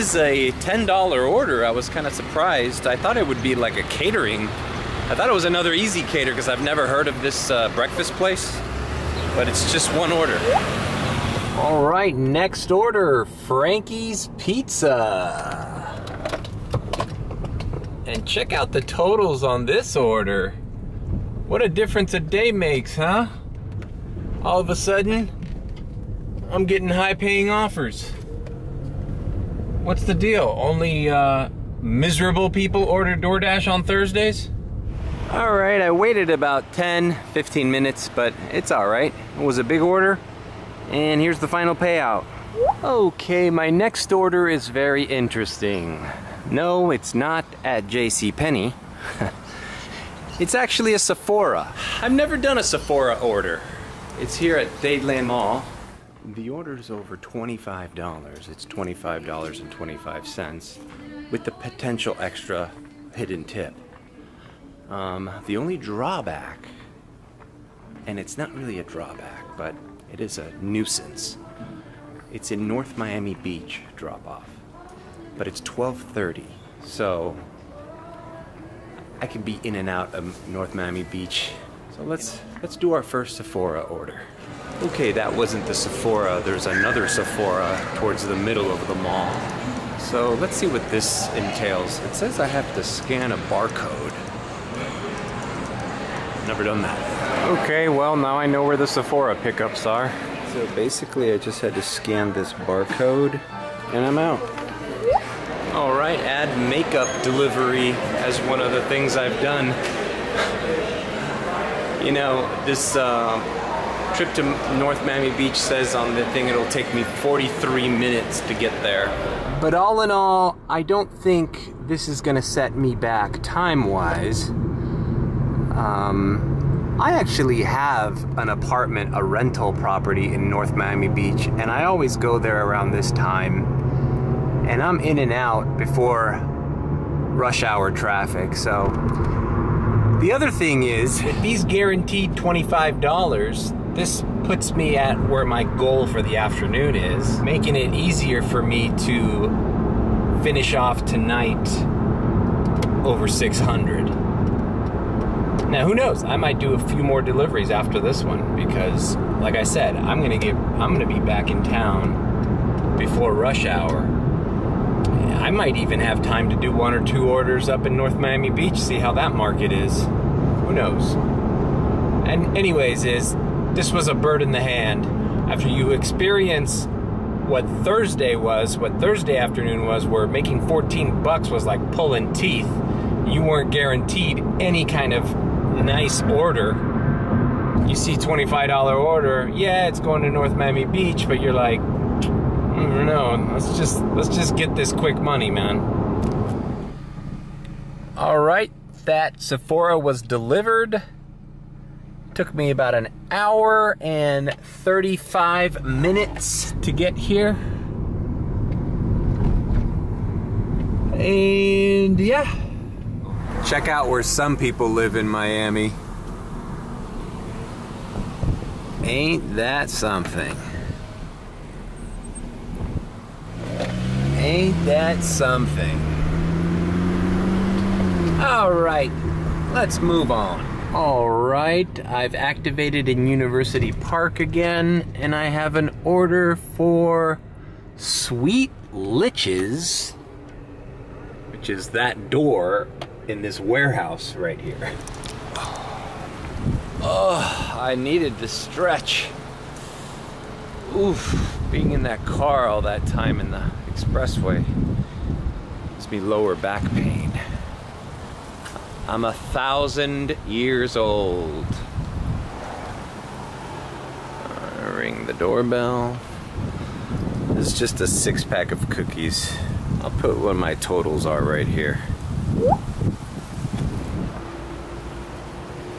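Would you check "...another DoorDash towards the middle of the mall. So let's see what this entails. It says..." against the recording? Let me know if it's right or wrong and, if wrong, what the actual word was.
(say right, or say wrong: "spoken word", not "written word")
wrong: "Sephora", not "DoorDash".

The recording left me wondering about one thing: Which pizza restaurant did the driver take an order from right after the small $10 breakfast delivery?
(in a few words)
Frankie's Pizza.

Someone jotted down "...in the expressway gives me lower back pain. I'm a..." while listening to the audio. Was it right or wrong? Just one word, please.
right.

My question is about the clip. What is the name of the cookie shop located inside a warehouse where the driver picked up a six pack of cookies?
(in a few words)
Sweet Liches.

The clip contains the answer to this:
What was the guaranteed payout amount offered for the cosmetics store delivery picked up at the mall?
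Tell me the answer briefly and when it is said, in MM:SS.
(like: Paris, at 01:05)
$25.25, at 00:58.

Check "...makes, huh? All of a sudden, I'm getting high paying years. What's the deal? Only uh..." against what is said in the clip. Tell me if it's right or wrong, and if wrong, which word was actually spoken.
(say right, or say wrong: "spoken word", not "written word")
wrong: "offers", not "years".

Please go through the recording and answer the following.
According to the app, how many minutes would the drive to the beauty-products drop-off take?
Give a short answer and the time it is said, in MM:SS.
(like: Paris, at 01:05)
43, at 01:57.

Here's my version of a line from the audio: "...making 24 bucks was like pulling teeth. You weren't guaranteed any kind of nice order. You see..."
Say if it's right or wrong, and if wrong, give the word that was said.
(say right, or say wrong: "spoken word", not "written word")
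wrong: "14", not "24".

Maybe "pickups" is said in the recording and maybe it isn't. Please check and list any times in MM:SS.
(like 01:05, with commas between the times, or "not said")
01:39.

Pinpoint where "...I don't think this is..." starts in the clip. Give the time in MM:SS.
02:00.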